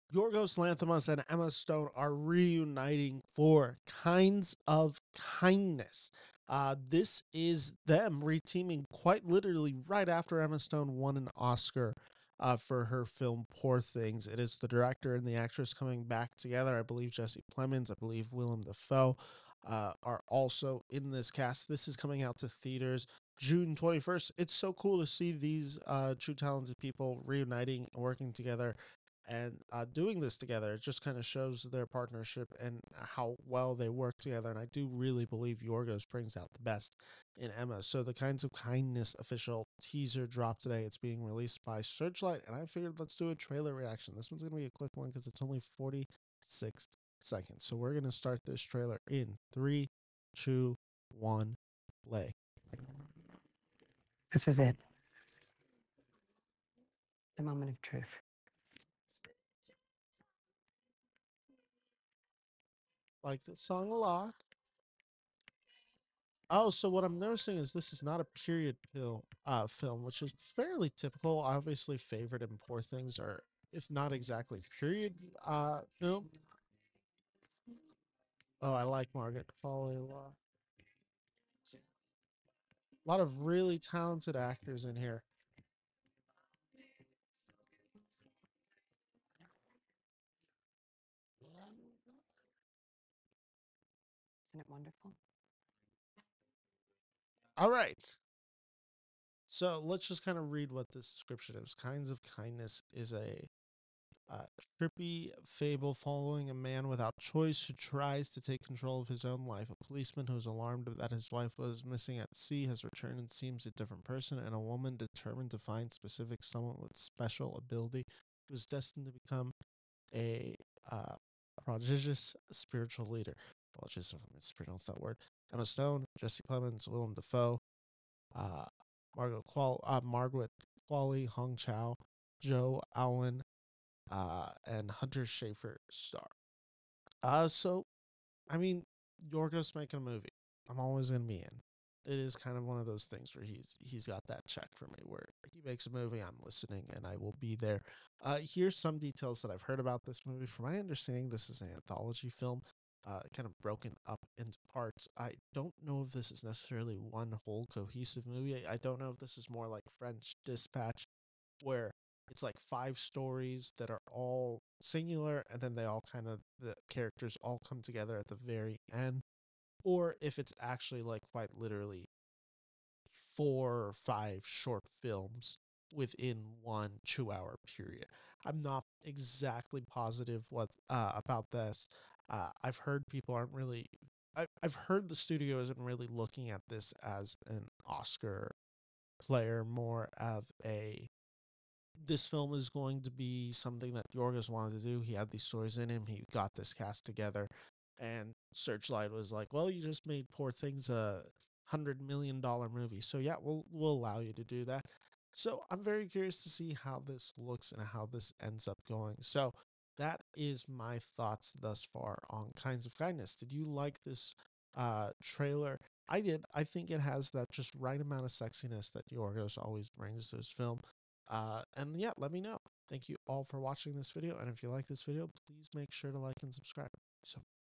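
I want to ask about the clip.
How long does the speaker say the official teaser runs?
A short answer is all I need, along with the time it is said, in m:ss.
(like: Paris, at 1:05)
46 seconds, at 0:45.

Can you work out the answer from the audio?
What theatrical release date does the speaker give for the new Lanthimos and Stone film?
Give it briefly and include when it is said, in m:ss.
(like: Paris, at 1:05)
June 21st, at 0:23.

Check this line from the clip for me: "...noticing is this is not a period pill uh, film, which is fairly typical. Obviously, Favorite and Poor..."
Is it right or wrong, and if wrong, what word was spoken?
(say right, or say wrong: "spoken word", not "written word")
right.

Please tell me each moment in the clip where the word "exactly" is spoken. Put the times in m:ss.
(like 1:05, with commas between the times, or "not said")
1:14, 2:59.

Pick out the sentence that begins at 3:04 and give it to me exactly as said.
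I, I've heard the studio isn't really looking at this as an Oscar player, more of a.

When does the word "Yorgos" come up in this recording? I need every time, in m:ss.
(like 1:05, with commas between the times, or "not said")
0:00, 0:35, 2:19, 3:14, 3:39.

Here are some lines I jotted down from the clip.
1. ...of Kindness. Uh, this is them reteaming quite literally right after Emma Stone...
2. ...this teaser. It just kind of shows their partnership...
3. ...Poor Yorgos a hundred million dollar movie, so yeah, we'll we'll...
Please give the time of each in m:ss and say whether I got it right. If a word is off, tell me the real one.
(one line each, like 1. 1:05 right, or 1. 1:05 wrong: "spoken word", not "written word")
1. 0:04 right
2. 0:30 wrong: "together", not "teaser"
3. 3:20 wrong: "Things", not "Yorgos".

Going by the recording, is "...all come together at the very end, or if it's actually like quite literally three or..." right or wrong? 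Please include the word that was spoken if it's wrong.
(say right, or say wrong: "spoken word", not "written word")
wrong: "four", not "three".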